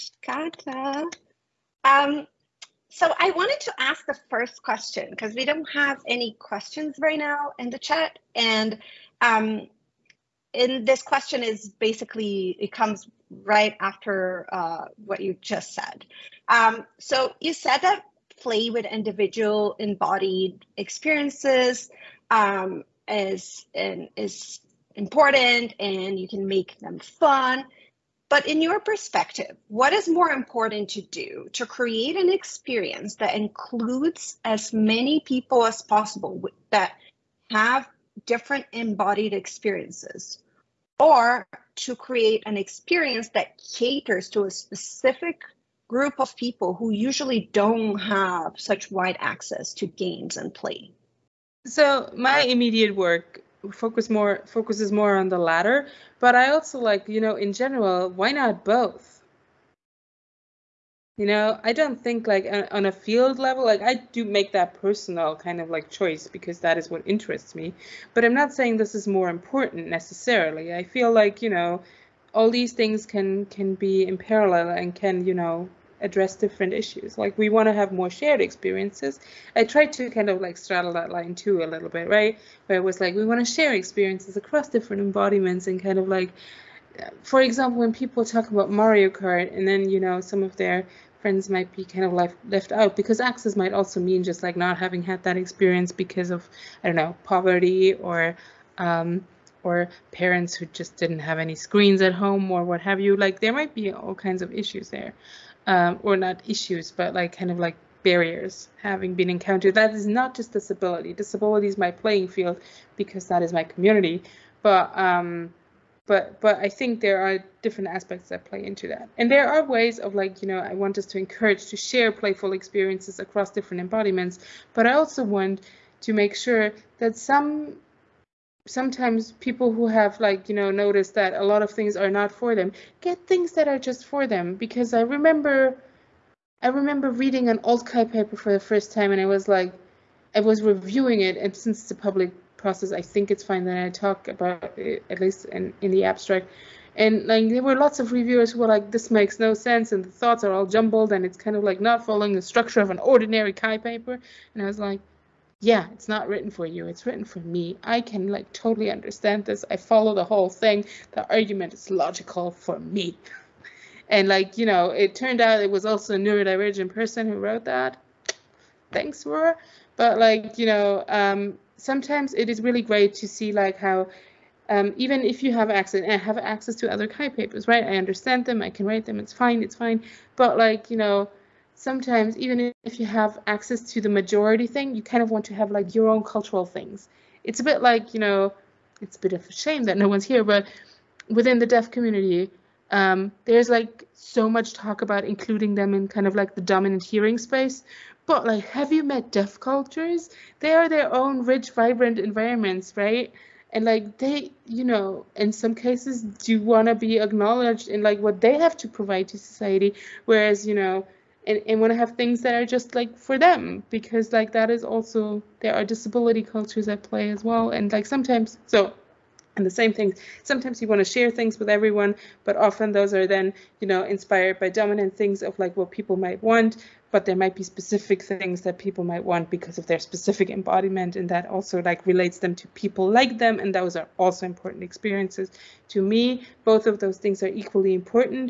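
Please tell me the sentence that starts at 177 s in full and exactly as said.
I understand them, I can read them, it's fine, it's fine.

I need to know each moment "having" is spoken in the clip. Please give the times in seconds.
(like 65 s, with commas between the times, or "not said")
94 s, 108 s.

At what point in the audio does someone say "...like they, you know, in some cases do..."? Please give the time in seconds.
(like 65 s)
203 s.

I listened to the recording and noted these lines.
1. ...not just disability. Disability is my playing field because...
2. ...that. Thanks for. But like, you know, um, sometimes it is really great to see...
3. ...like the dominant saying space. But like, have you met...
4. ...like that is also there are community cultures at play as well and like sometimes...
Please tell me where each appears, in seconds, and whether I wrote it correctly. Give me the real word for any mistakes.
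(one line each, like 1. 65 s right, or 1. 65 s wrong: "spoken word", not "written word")
1. 110 s right
2. 167 s right
3. 196 s wrong: "hearing", not "saying"
4. 214 s wrong: "disability", not "community".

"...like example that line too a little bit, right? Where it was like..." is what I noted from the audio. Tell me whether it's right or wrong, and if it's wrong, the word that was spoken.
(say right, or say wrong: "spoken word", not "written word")
wrong: "straddle", not "example".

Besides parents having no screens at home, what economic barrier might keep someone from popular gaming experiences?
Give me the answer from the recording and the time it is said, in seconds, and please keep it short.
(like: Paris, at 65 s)
poverty, at 97 s.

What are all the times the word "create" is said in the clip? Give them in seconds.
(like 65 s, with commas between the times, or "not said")
31 s, 41 s.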